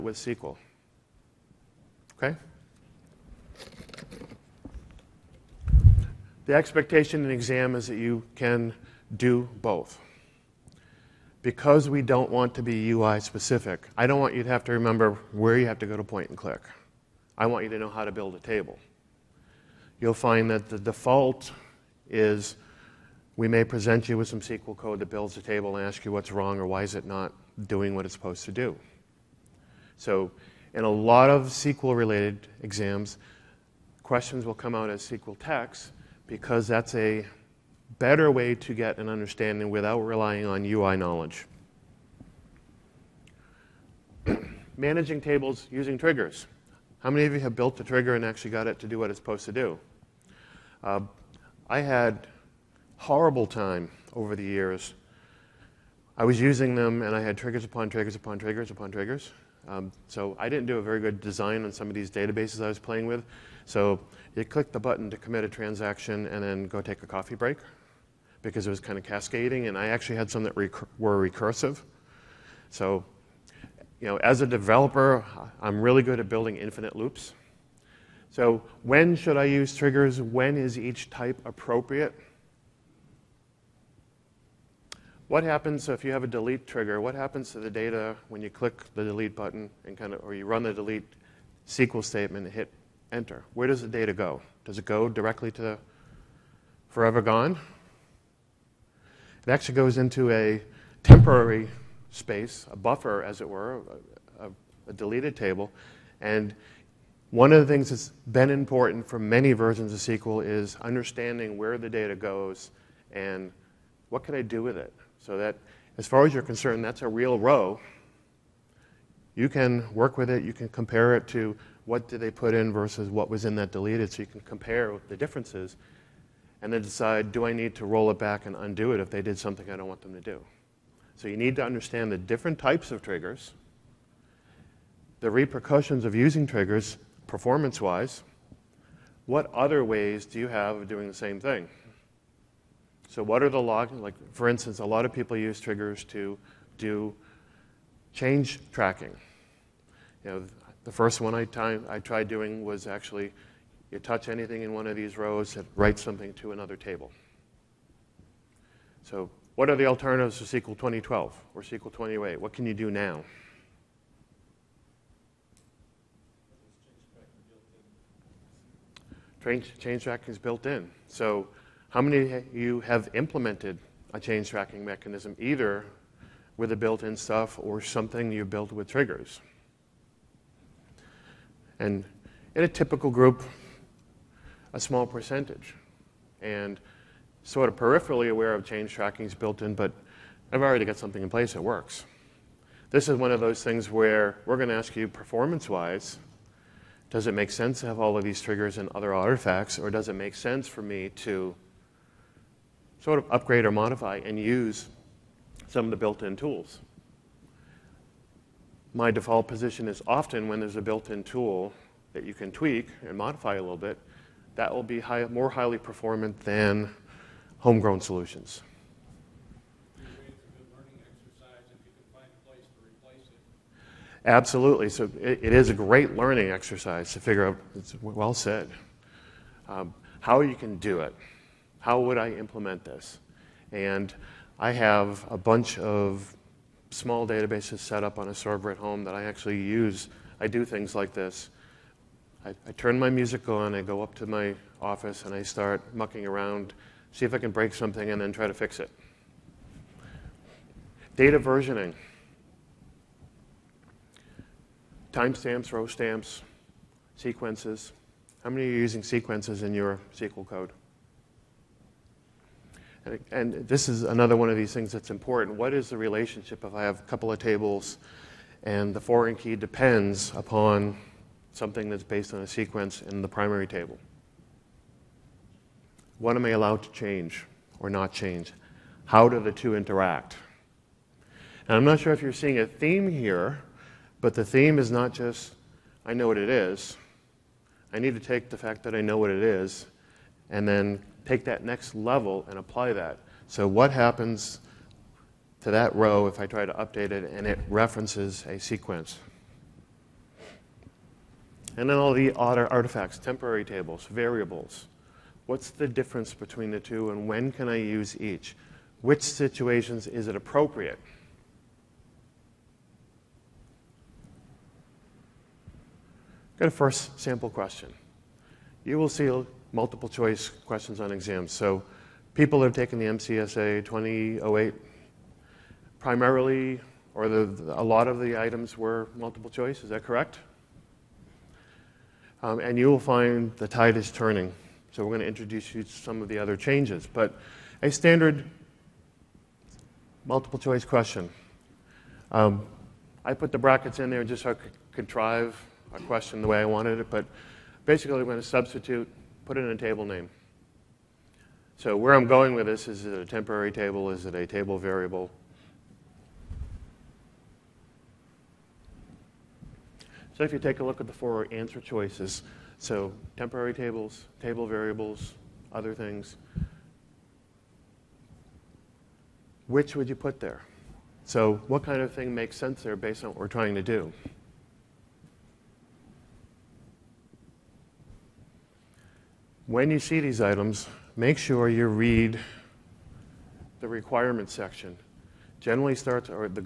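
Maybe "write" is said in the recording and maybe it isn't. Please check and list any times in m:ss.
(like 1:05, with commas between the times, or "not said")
2:35.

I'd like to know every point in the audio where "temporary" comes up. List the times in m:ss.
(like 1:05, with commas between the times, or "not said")
1:41, 5:03, 5:53, 6:03.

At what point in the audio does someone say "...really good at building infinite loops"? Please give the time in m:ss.
1:15.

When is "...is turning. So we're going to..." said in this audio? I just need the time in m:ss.
5:33.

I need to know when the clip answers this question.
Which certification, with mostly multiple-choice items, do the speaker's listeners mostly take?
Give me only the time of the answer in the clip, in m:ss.
5:23.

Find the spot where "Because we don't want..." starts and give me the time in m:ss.
0:11.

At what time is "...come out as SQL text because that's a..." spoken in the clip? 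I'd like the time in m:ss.
0:34.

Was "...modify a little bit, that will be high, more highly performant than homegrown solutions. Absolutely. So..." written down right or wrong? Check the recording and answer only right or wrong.
right.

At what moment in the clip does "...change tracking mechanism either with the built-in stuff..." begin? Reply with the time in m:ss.
2:54.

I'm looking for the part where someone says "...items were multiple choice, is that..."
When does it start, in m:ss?
5:28.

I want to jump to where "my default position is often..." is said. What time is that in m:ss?
3:28.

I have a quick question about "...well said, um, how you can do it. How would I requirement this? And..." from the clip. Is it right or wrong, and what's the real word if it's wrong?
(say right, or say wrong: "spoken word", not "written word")
wrong: "implement", not "requirement".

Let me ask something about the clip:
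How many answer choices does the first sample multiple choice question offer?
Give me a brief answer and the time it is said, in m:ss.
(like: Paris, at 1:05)
4, at 6:01.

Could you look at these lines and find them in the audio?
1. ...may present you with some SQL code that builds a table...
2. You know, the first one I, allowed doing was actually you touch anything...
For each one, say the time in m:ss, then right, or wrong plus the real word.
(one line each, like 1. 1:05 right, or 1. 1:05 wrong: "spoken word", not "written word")
1. 0:23 right
2. 2:30 wrong: "tried", not "allowed".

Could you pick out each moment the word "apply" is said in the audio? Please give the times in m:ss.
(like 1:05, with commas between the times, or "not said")
4:52.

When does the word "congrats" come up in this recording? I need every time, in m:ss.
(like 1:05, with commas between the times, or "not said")
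not said.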